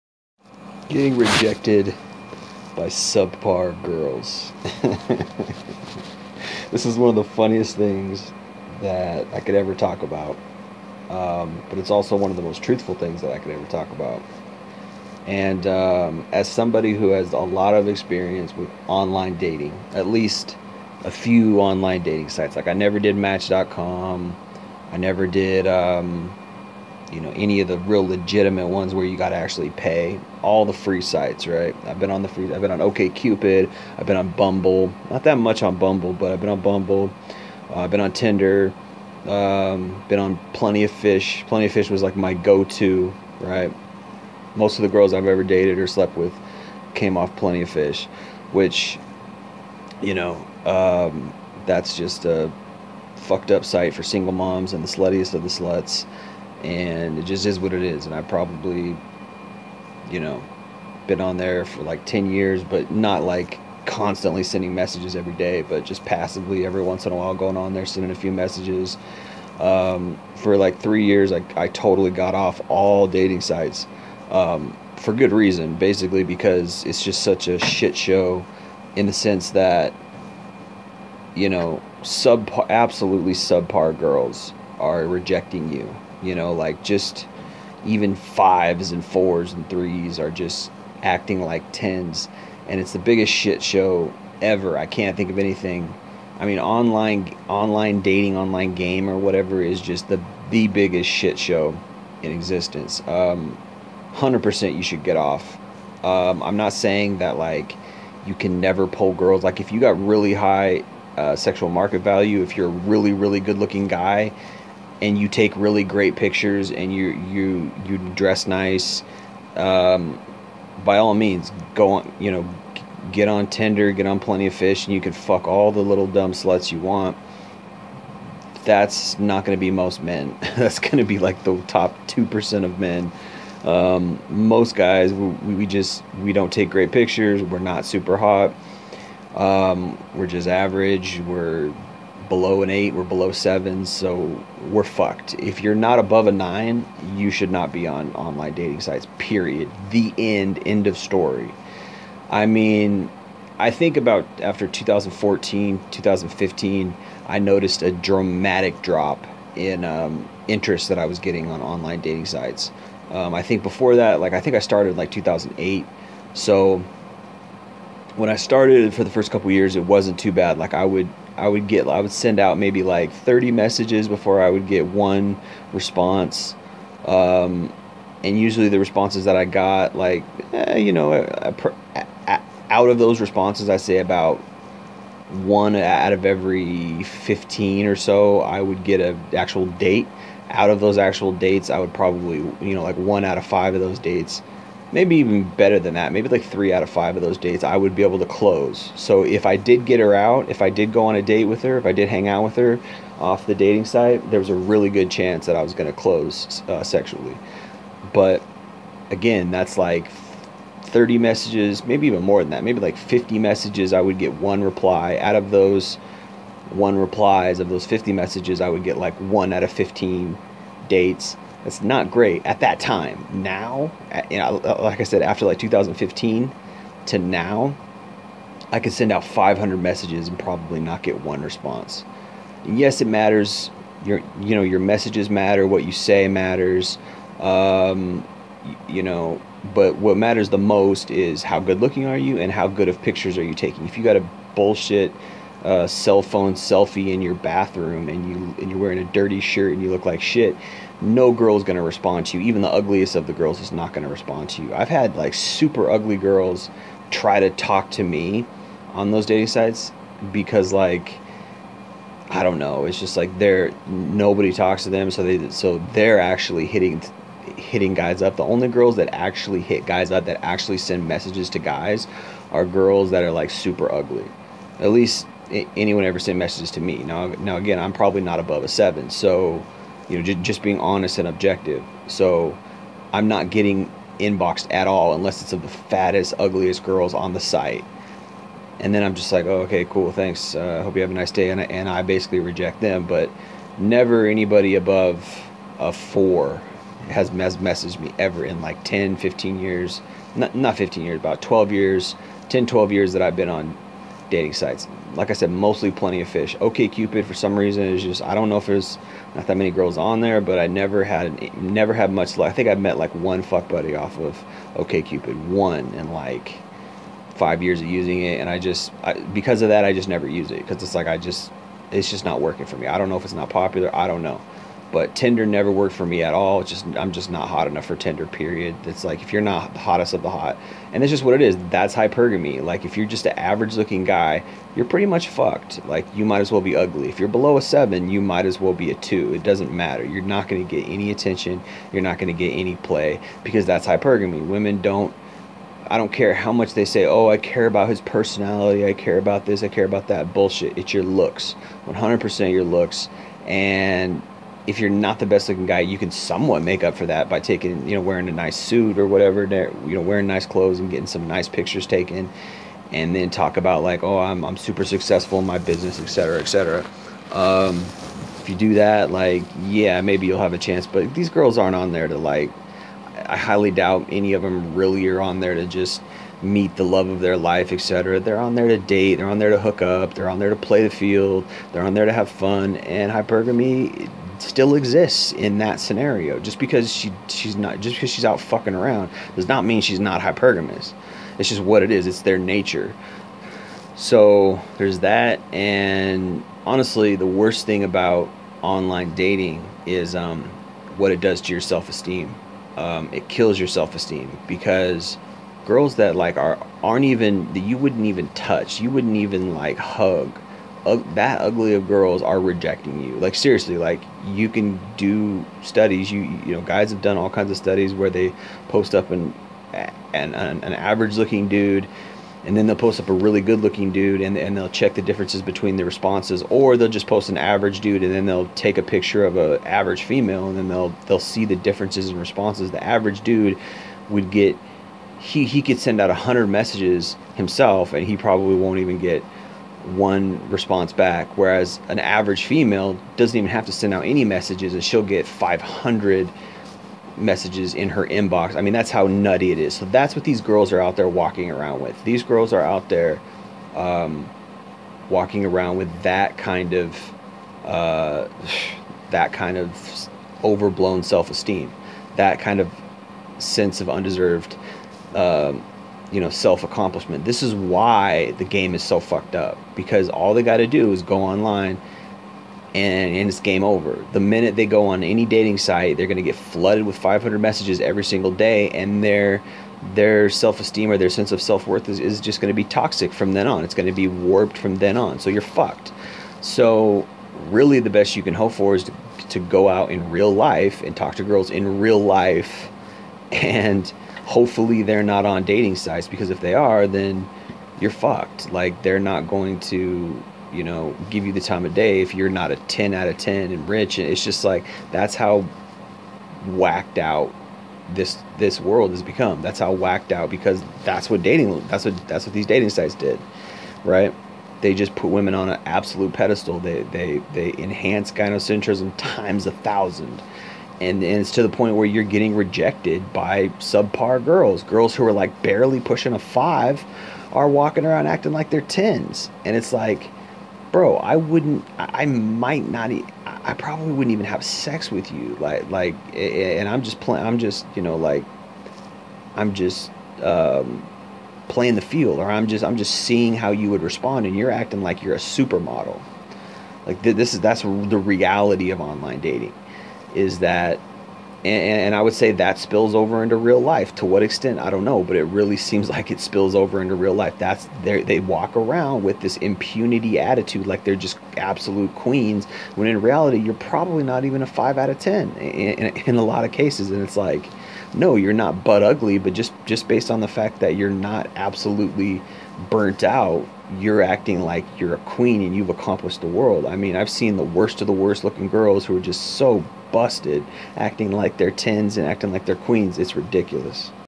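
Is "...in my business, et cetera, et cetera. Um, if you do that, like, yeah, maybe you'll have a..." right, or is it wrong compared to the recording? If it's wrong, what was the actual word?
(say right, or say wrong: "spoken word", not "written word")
right.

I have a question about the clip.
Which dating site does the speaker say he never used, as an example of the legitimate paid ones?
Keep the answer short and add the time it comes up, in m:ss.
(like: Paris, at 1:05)
Match.com, at 0:23.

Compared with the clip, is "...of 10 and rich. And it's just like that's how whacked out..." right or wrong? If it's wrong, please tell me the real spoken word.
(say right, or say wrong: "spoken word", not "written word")
right.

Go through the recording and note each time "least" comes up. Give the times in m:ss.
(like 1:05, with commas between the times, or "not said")
0:20, 4:34.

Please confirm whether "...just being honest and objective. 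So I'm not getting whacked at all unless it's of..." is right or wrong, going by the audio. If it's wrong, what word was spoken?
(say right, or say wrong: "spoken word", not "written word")
wrong: "inboxed", not "whacked".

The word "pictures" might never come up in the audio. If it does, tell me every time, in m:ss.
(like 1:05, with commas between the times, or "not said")
1:56, 2:16, 4:03, 6:01, 7:08.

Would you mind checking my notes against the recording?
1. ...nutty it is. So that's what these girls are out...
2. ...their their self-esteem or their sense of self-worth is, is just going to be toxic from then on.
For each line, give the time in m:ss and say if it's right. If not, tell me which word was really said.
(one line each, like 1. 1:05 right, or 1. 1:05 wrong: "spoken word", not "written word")
1. 7:29 right
2. 7:59 right.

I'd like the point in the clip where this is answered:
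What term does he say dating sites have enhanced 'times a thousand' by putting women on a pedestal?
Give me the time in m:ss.
8:38.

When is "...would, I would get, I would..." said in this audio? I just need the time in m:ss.
2:50.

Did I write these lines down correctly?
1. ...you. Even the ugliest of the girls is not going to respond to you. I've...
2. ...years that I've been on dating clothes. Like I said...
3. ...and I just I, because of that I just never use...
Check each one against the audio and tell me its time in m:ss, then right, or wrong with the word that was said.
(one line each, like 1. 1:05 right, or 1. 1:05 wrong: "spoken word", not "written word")
1. 4:12 right
2. 5:02 wrong: "sites", not "clothes"
3. 5:18 right.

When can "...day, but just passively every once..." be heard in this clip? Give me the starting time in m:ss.
1:05.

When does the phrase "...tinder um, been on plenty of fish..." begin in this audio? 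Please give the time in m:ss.
0:38.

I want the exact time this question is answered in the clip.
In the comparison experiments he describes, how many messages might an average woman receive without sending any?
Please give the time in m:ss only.
7:25.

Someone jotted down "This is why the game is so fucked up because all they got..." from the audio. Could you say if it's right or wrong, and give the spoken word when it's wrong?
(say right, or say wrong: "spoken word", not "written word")
right.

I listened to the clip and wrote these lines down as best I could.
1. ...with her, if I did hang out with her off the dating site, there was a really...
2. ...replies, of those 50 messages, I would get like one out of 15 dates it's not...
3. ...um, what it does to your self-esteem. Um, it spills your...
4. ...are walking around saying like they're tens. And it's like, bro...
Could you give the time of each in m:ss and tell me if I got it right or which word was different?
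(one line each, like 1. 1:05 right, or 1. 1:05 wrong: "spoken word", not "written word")
1. 3:21 right
2. 3:36 right
3. 6:40 wrong: "kills", not "spills"
4. 8:47 wrong: "acting", not "saying".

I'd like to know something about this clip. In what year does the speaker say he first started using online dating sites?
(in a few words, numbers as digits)
2008.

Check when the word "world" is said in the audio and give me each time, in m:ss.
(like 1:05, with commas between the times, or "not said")
8:28, 9:36.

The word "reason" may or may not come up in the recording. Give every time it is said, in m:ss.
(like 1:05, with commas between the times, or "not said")
1:15, 5:07.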